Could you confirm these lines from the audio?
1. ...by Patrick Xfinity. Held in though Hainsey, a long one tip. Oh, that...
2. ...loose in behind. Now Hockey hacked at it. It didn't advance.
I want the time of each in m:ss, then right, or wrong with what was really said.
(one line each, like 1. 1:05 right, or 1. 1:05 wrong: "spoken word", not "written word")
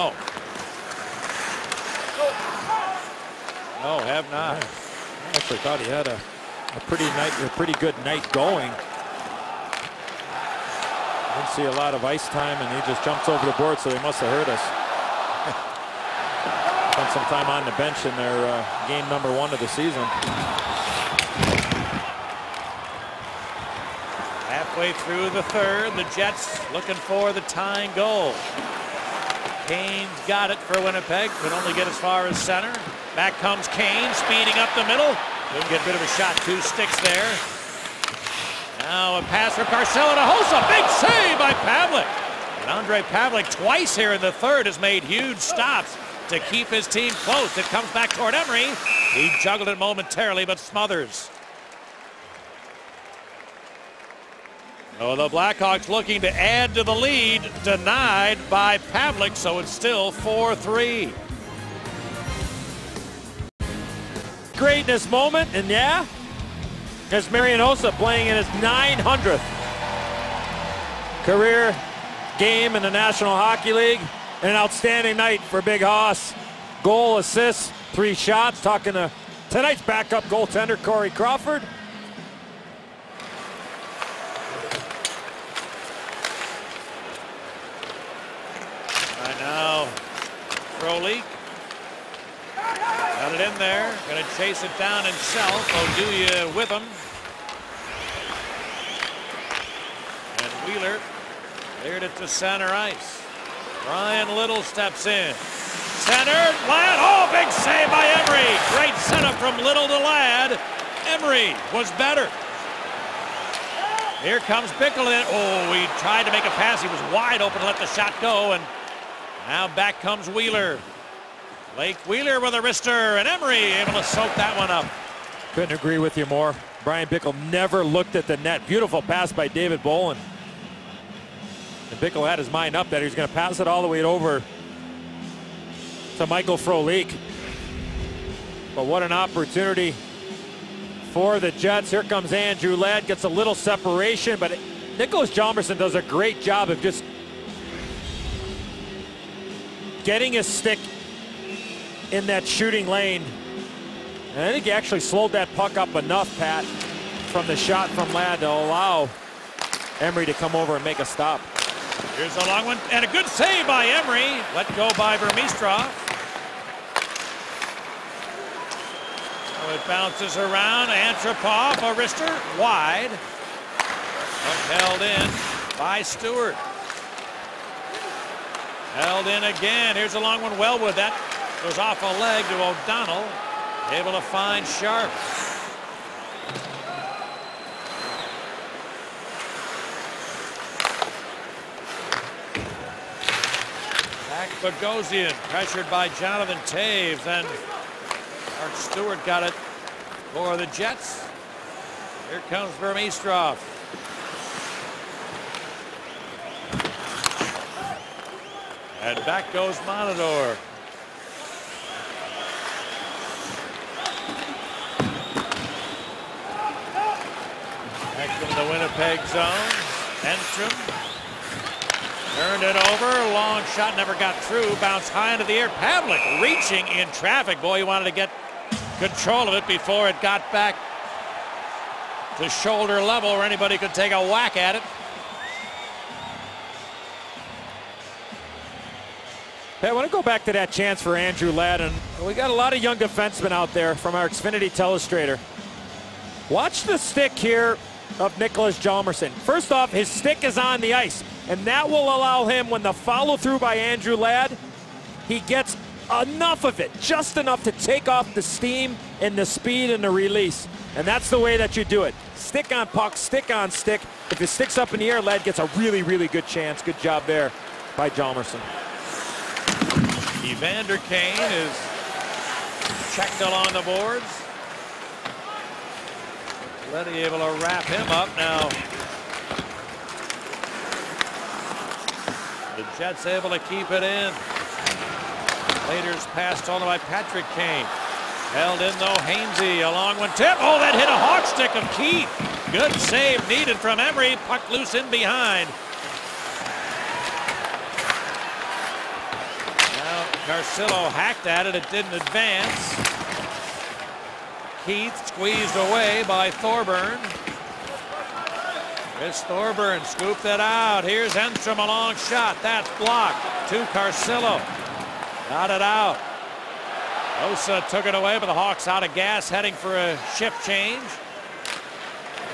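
1. 4:46 wrong: "Kane", not "Xfinity"
2. 4:54 wrong: "Carcillo", not "Hockey".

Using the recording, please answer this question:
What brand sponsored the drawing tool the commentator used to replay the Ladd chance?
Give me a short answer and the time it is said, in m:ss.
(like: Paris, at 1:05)
Xfinity, at 4:04.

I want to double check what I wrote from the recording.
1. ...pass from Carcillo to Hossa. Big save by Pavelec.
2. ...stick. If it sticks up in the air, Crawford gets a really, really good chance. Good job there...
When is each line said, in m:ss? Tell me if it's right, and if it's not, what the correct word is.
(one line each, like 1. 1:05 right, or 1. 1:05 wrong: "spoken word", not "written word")
1. 0:39 right
2. 4:23 wrong: "Ladd", not "Crawford".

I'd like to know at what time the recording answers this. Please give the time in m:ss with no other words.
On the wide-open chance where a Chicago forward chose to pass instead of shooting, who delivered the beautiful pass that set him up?
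2:09.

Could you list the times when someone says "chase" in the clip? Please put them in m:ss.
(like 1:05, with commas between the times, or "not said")
1:34.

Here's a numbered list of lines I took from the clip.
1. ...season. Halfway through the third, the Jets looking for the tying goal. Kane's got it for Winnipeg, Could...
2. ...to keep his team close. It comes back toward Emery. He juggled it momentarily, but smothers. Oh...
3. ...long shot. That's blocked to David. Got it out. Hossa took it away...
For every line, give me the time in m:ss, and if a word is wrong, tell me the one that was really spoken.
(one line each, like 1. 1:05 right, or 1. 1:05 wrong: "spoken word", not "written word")
1. 0:19 right
2. 0:46 right
3. 5:11 wrong: "Carcillo", not "David".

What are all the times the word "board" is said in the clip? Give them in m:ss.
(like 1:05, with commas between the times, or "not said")
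0:13, 4:33.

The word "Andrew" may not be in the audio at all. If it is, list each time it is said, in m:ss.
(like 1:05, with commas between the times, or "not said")
2:22, 4:01, 4:13.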